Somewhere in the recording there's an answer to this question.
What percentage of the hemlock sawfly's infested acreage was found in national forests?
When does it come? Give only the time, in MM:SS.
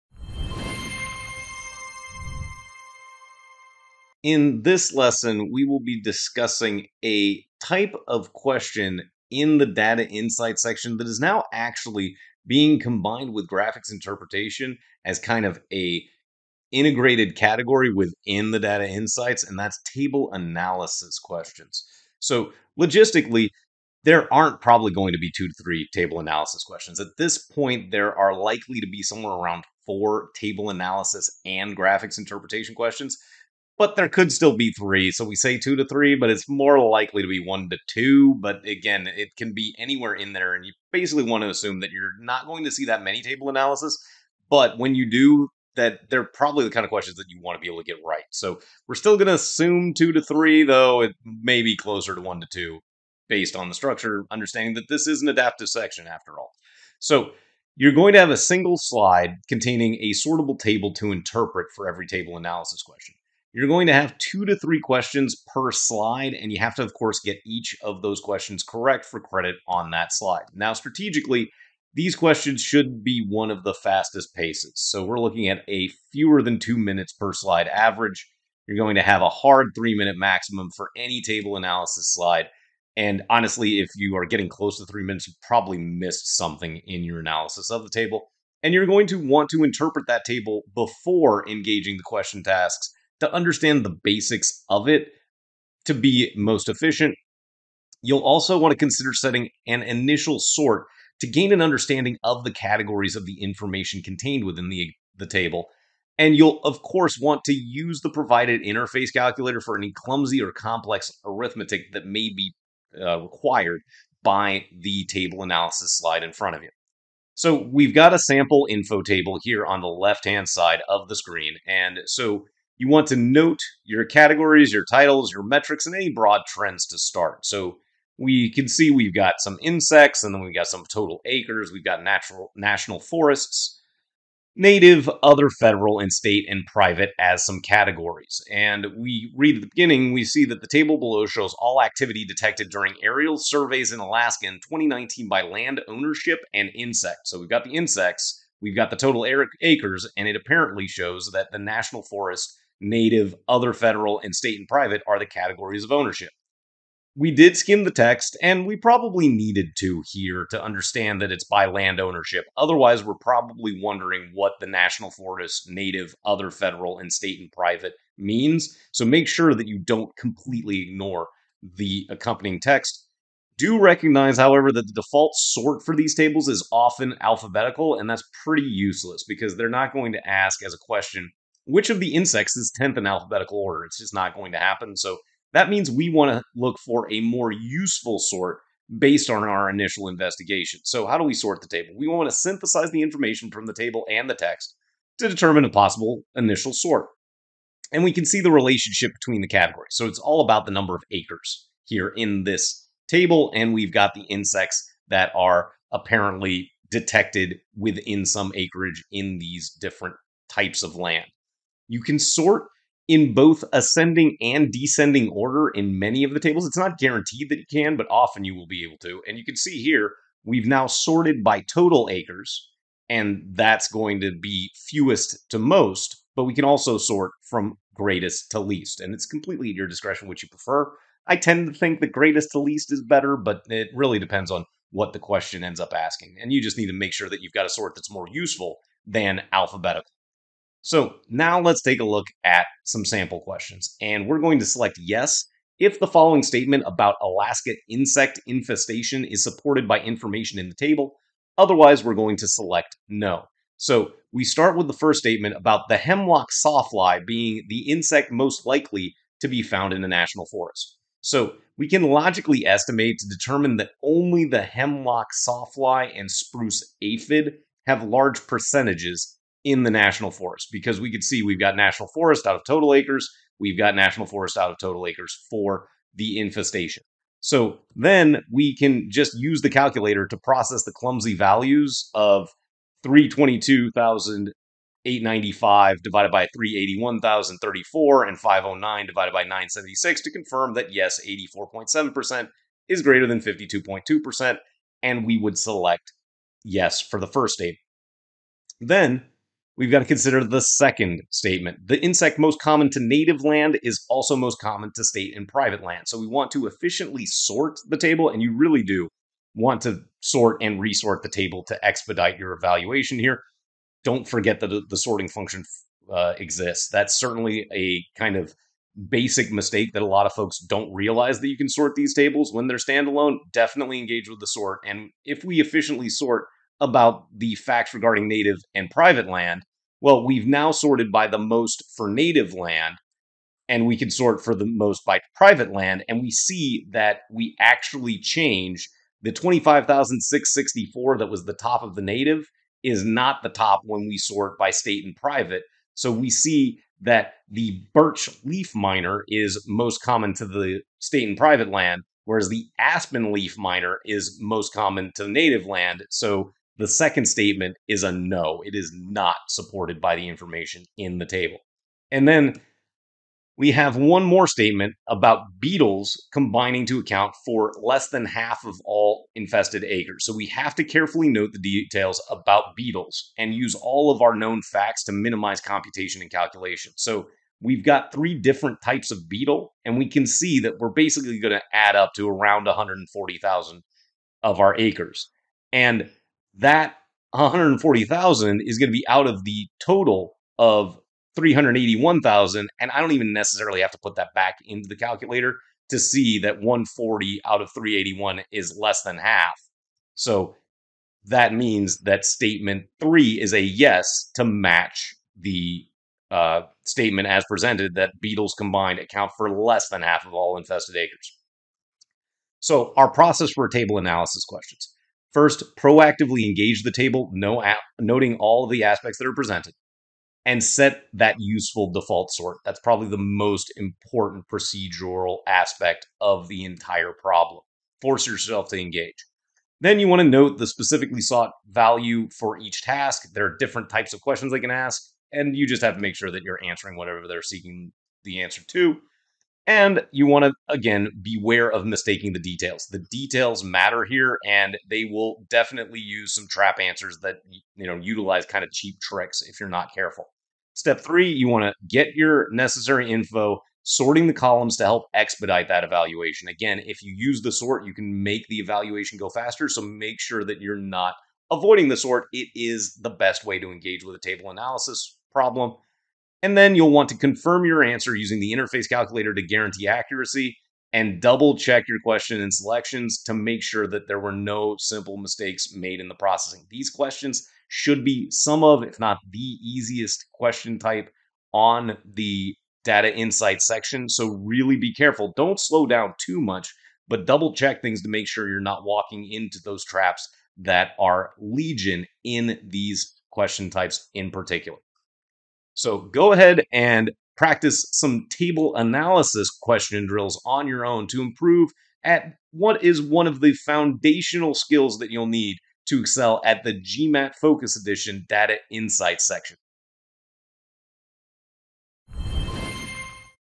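04:51.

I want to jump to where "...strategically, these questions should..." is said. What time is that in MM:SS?
01:10.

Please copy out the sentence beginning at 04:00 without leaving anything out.
So now let's take a look at some sample questions.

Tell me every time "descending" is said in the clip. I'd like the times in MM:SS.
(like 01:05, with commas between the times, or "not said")
03:34.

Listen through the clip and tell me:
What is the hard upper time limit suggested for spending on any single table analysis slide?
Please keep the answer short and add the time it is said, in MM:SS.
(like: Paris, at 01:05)
3 minutes, at 01:19.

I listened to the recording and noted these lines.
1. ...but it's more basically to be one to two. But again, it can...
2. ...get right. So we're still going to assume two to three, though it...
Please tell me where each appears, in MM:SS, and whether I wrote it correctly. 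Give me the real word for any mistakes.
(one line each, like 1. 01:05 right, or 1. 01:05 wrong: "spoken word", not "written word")
1. 00:36 wrong: "likely", not "basically"
2. 00:47 right.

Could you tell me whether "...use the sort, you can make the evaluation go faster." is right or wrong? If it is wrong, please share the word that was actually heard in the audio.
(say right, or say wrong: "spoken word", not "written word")
right.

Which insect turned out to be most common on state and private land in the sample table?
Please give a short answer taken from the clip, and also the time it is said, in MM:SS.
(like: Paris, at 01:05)
birch leaf miner, at 05:47.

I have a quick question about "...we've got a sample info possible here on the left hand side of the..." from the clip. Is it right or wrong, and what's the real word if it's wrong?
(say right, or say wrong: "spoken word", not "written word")
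wrong: "table", not "possible".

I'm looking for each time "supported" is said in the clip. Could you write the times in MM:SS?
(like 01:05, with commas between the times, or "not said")
04:09, 05:59.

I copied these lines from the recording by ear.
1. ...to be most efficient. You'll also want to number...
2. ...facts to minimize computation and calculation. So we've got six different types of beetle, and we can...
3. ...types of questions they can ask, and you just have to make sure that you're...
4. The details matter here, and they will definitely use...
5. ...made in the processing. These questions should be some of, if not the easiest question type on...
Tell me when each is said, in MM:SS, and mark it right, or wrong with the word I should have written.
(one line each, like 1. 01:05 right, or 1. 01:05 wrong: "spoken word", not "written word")
1. 01:35 wrong: "consider", not "number"
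2. 06:14 wrong: "three", not "six"
3. 07:13 right
4. 07:22 right
5. 07:55 right.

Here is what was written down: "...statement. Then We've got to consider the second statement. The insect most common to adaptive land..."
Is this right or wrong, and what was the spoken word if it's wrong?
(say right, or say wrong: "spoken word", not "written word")
wrong: "native", not "adaptive".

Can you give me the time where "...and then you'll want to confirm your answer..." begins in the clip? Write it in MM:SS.
07:46.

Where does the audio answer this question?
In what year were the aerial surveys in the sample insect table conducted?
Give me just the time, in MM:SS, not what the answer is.
02:24.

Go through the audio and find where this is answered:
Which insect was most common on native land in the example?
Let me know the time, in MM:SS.
05:52.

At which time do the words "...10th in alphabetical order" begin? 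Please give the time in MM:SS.
03:02.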